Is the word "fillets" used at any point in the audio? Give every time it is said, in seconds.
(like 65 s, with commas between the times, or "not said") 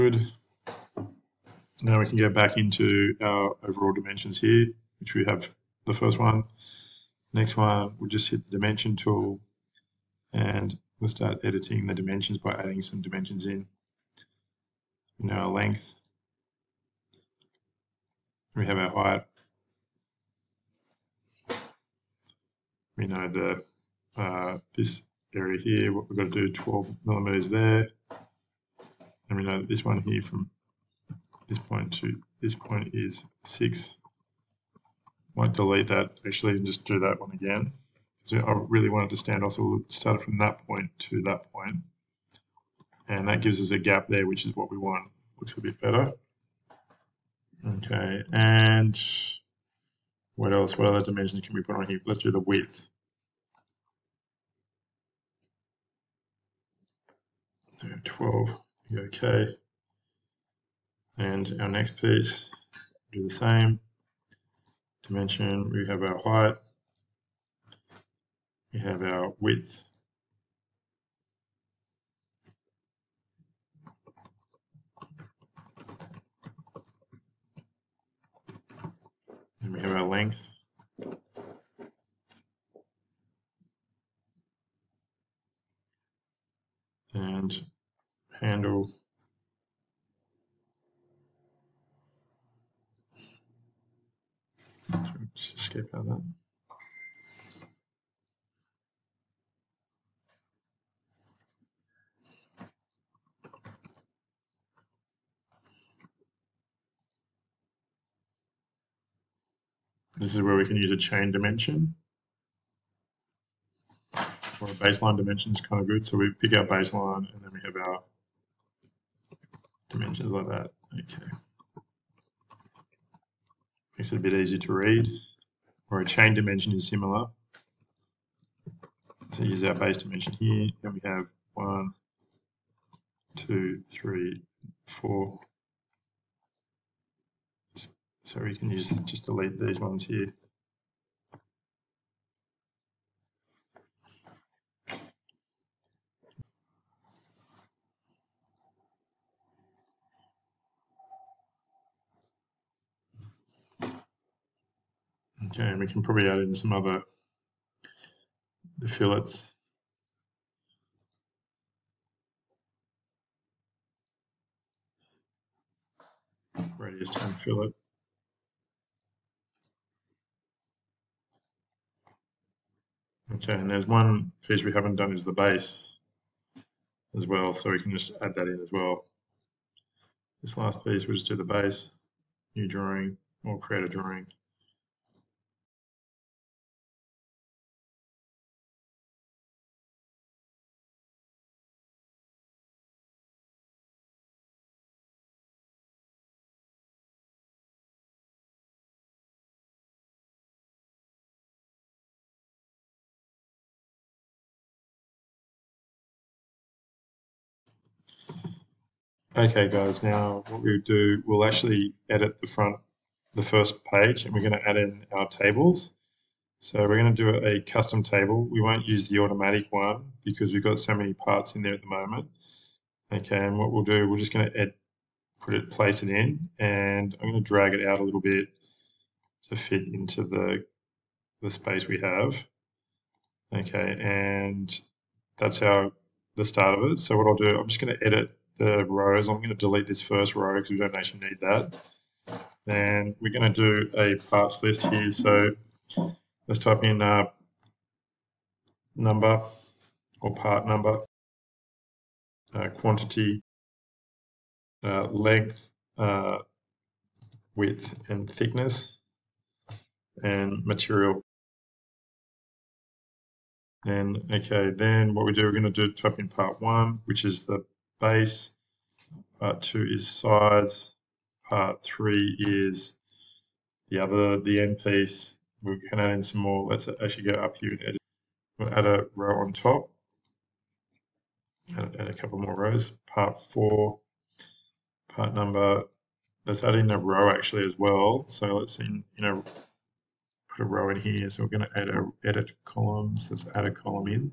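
158 s, 167 s.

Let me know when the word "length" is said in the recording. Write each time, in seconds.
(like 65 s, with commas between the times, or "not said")
15 s, 80 s, 255 s.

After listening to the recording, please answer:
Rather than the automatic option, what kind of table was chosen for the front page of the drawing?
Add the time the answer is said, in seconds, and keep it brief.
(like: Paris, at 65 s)
custom table, at 217 s.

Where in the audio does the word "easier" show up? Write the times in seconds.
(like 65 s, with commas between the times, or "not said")
124 s.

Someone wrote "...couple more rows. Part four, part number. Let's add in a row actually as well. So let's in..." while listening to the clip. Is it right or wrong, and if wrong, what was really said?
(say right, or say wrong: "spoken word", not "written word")
right.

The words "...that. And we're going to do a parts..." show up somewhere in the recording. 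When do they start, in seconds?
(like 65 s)
241 s.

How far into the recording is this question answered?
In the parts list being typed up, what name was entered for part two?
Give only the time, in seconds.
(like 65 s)
270 s.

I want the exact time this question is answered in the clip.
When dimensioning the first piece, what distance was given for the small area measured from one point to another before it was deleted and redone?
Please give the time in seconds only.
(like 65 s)
33 s.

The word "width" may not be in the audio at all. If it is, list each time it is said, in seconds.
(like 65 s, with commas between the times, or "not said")
52 s, 69 s, 257 s.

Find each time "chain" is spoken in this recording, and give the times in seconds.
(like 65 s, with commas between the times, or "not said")
110 s, 126 s.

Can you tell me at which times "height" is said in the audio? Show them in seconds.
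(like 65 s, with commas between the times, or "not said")
18 s, 66 s.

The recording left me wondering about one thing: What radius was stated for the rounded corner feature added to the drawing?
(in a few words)
10.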